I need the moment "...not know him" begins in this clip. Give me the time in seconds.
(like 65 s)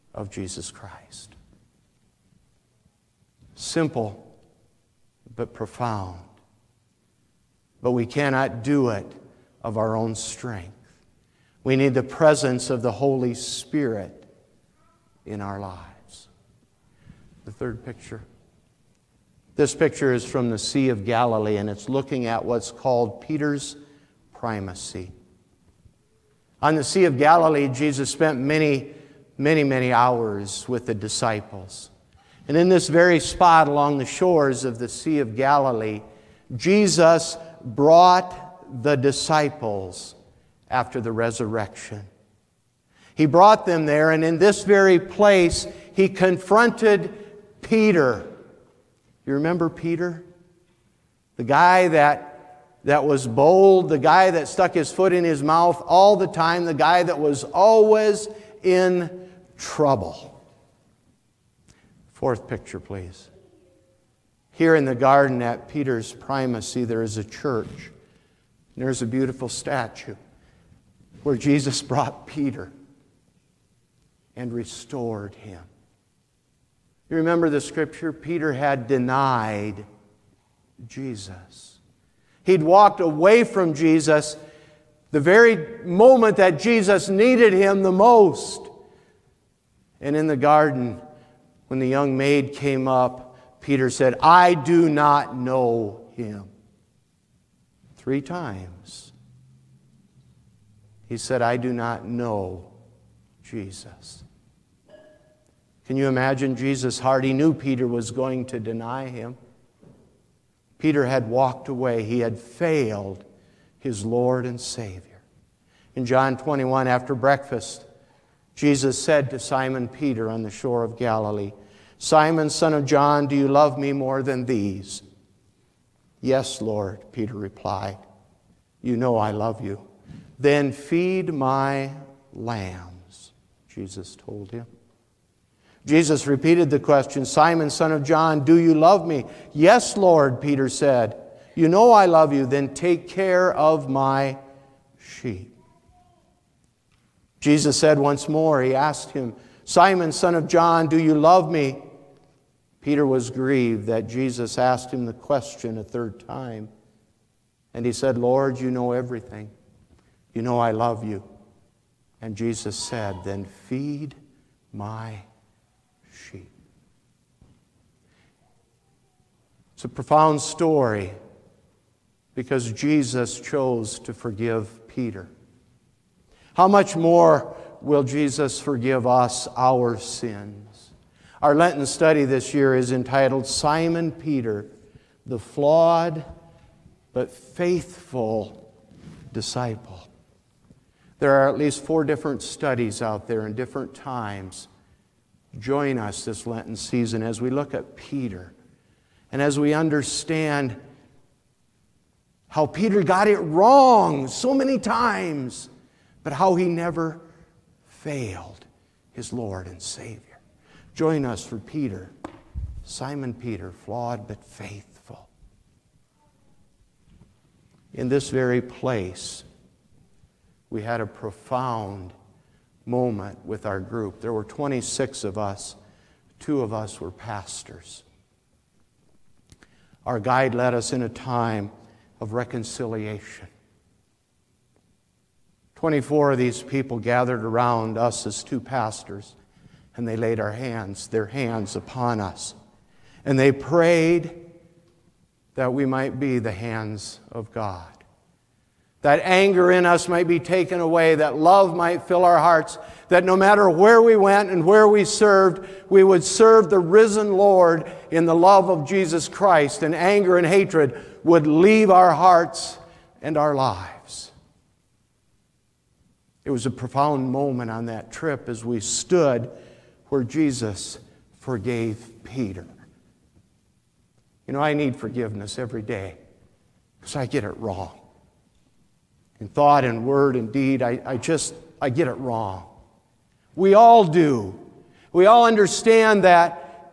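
94 s.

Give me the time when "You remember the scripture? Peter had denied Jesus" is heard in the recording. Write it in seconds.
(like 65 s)
77 s.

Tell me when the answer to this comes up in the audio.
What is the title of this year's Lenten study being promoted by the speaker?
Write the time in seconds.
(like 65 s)
183 s.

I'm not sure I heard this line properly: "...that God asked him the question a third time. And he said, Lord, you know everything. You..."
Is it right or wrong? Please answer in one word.
wrong.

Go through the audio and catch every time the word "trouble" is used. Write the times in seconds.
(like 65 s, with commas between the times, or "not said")
59 s.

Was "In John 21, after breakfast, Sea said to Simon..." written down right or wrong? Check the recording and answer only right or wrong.
wrong.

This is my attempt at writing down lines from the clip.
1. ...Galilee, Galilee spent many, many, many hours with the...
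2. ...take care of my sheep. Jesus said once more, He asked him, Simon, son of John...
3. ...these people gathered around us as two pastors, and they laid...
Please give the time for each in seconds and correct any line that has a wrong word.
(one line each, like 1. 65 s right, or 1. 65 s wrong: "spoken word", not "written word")
1. 27 s wrong: "Jesus", not "Galilee"
2. 142 s right
3. 236 s right.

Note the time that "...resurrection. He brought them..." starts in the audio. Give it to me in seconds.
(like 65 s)
41 s.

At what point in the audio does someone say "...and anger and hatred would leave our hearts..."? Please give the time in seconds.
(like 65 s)
259 s.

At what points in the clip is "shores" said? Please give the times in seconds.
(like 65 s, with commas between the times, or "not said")
34 s, 120 s.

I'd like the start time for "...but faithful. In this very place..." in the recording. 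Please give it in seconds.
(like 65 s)
214 s.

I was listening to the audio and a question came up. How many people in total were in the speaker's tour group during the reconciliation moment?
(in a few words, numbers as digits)
26.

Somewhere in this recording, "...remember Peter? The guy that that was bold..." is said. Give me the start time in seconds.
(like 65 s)
49 s.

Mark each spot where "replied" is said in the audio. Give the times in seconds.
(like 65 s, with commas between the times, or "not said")
127 s.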